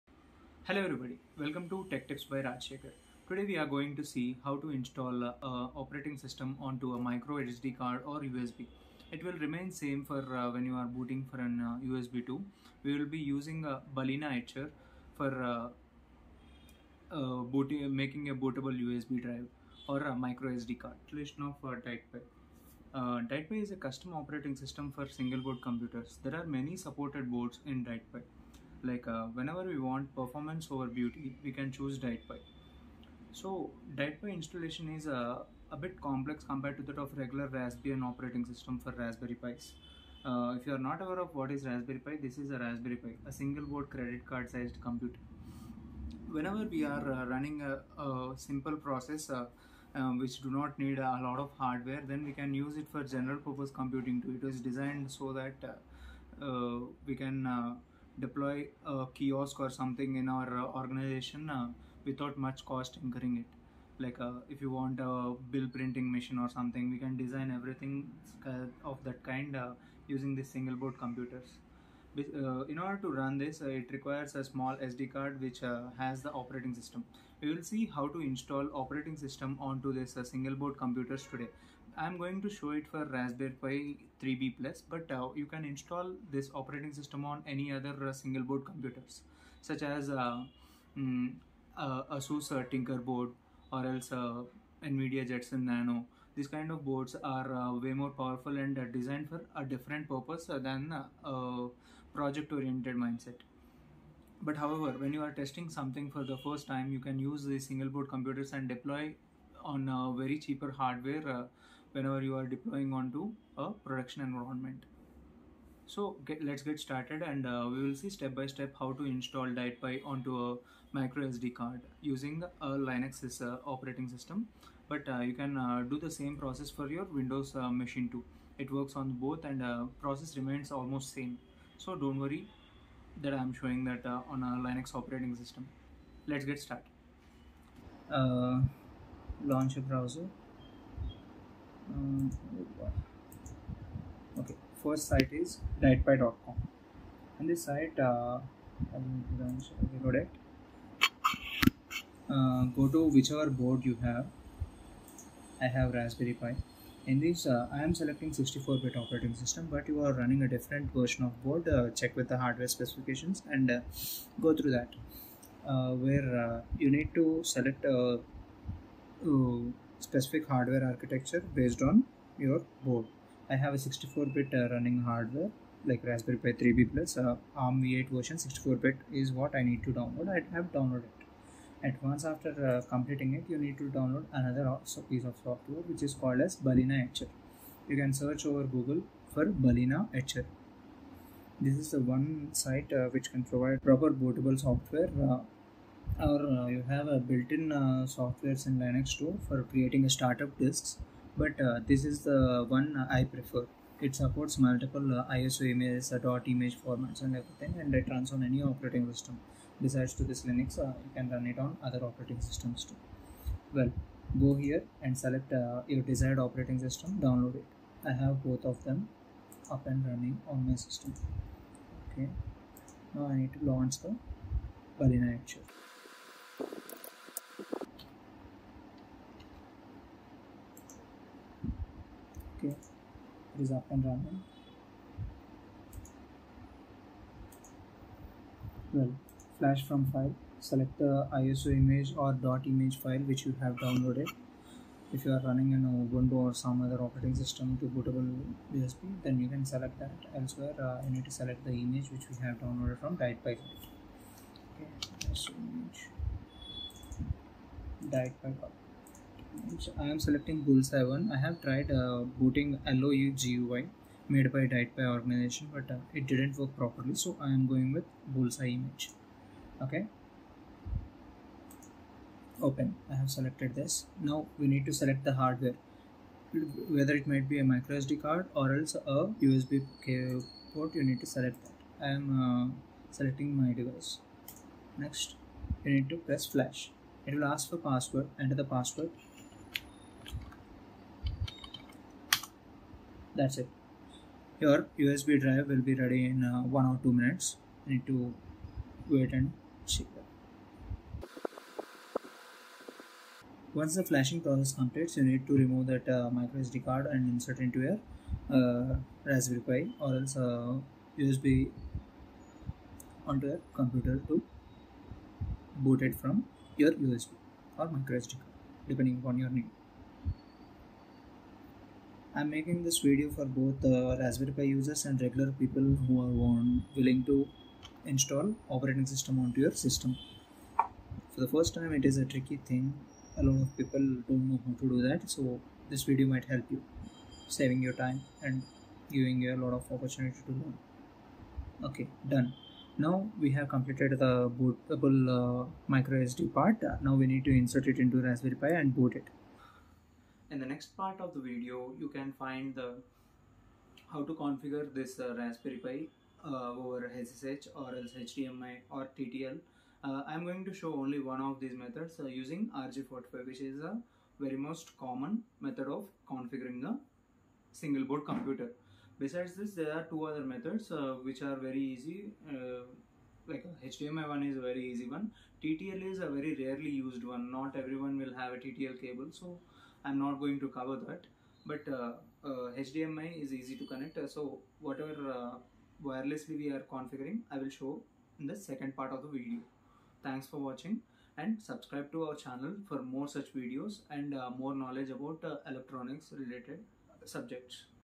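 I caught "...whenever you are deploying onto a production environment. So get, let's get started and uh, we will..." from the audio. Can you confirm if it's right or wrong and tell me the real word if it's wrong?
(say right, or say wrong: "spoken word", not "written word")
right.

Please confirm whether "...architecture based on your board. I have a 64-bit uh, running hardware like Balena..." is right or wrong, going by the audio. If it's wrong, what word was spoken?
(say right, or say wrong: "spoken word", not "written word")
wrong: "Raspberry", not "Balena".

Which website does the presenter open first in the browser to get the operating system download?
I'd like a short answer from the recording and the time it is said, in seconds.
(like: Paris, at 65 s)
dietpi.com, at 145 s.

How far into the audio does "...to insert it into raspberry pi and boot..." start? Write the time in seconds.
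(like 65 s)
347 s.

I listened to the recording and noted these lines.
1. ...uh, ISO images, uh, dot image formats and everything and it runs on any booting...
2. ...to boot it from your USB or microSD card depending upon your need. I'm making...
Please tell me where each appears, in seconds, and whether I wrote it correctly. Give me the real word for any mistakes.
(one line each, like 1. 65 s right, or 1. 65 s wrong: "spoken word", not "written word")
1. 205 s wrong: "operating", not "booting"
2. 314 s right.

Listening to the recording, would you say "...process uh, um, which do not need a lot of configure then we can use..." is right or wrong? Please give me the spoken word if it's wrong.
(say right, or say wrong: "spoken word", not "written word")
wrong: "hardware", not "configure".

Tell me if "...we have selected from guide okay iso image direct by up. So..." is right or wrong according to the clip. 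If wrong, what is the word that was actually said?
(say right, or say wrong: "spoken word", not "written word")
wrong: "downloaded", not "selected".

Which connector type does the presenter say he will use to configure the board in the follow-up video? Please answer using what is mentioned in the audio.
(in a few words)
RJ45.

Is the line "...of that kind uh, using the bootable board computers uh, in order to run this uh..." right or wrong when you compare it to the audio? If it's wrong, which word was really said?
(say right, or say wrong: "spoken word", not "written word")
wrong: "single", not "bootable".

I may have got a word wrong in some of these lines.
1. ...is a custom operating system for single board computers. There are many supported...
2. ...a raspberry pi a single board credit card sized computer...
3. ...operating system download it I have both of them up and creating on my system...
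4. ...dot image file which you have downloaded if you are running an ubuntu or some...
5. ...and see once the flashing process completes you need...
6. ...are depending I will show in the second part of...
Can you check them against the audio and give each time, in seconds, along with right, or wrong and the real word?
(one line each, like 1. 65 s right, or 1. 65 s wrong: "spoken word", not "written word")
1. 23 s right
2. 42 s right
3. 216 s wrong: "running", not "creating"
4. 242 s right
5. 299 s right
6. 386 s wrong: "configuring", not "depending".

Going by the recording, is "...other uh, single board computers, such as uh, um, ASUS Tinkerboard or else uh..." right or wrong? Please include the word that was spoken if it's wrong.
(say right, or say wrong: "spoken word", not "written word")
right.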